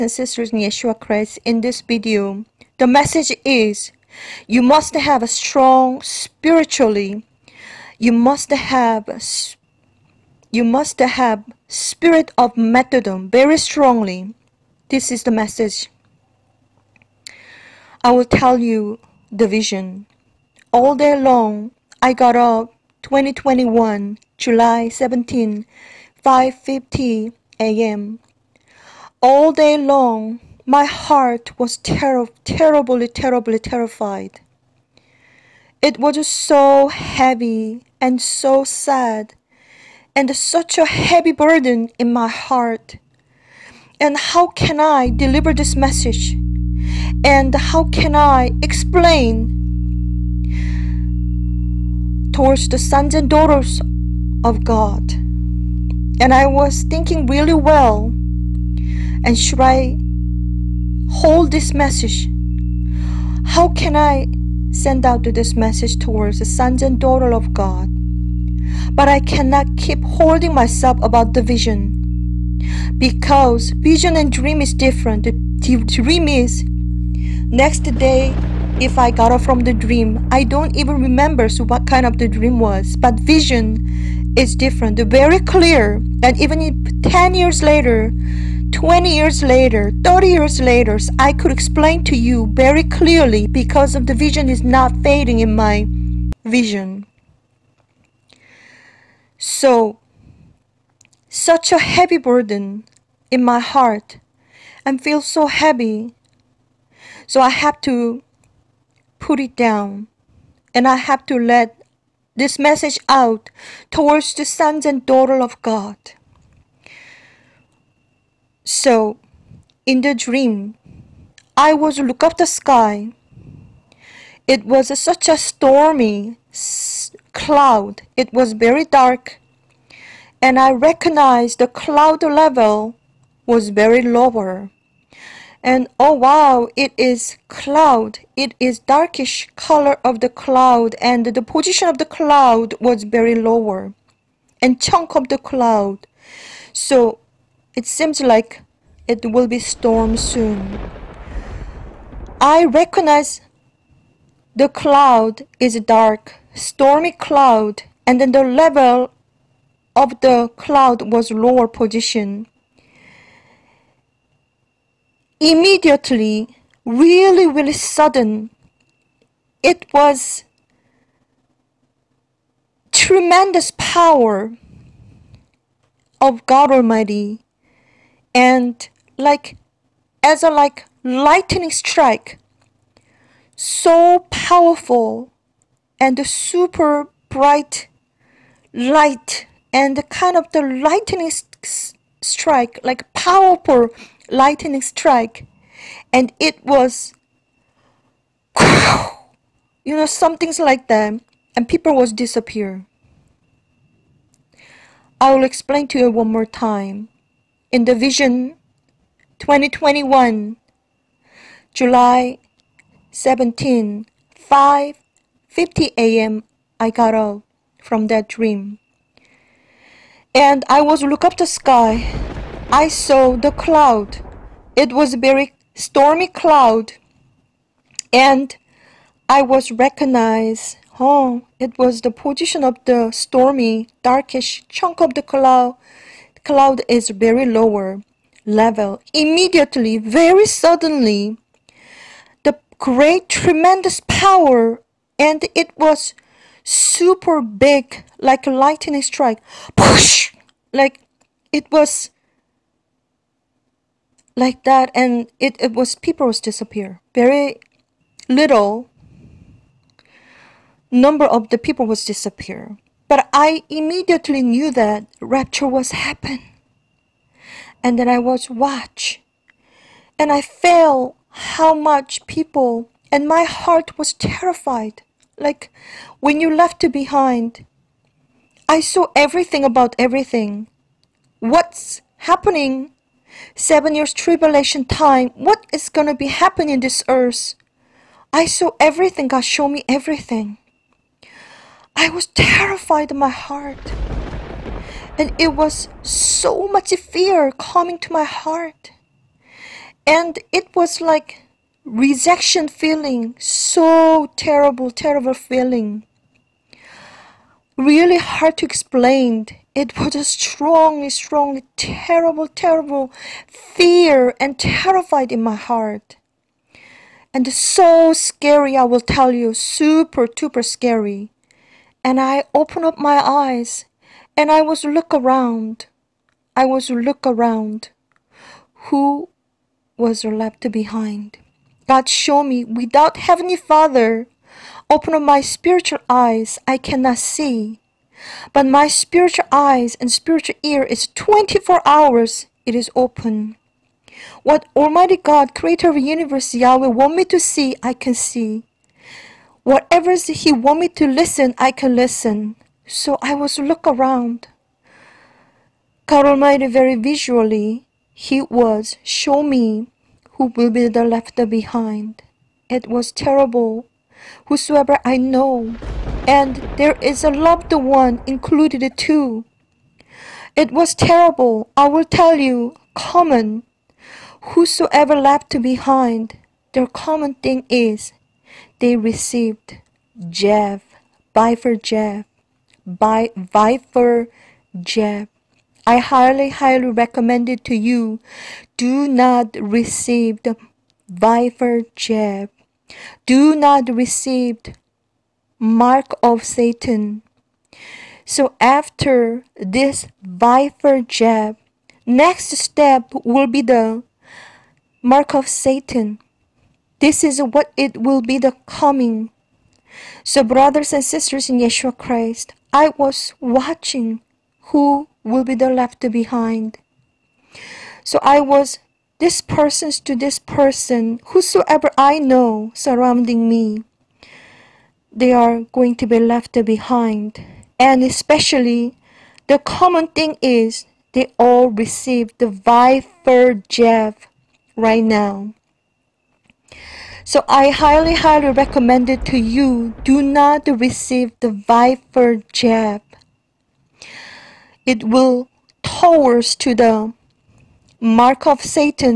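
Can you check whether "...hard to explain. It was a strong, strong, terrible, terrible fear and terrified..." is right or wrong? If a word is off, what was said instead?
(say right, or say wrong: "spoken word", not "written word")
right.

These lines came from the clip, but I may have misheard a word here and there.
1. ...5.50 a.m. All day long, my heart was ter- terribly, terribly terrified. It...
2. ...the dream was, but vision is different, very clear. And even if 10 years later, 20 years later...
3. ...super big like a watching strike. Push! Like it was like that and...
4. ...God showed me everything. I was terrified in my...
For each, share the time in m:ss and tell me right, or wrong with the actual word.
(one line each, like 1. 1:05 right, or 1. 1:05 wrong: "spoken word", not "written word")
1. 0:26 right
2. 1:22 right
3. 4:06 wrong: "lightning", not "watching"
4. 4:49 right.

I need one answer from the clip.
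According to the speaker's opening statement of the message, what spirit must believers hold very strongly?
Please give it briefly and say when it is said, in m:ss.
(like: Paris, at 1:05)
spirit of martyrdom, at 0:11.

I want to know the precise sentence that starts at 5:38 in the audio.
But my spiritual eyes and spiritual ear is 24 hours, it is open.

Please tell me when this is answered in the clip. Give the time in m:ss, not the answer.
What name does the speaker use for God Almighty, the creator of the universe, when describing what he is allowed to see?
5:46.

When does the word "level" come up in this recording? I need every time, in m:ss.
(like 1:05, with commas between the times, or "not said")
2:12, 2:38, 3:58.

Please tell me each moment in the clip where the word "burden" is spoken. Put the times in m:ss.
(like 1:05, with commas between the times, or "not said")
0:41, 1:42.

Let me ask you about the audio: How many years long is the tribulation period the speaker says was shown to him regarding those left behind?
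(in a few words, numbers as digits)
7.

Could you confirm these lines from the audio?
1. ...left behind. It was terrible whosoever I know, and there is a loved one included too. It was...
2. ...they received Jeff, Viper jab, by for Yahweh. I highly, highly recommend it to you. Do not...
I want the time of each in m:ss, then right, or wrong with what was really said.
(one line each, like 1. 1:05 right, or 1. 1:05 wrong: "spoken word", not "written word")
1. 6:01 right
2. 6:18 wrong: "Jeff", not "Yahweh".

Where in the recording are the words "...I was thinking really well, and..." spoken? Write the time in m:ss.
0:56.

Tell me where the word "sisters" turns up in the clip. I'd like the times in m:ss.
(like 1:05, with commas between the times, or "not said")
0:00, 6:51.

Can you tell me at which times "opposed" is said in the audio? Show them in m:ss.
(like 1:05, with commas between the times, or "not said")
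not said.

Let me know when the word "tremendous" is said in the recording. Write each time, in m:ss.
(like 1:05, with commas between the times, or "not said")
2:52, 4:03.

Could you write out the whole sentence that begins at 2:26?
So it seems like it will be storm soon.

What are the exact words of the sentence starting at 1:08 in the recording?
But I cannot keep holding myself about the vision because vision and dream is different.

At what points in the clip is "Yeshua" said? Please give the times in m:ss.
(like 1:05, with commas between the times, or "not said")
0:00, 6:51.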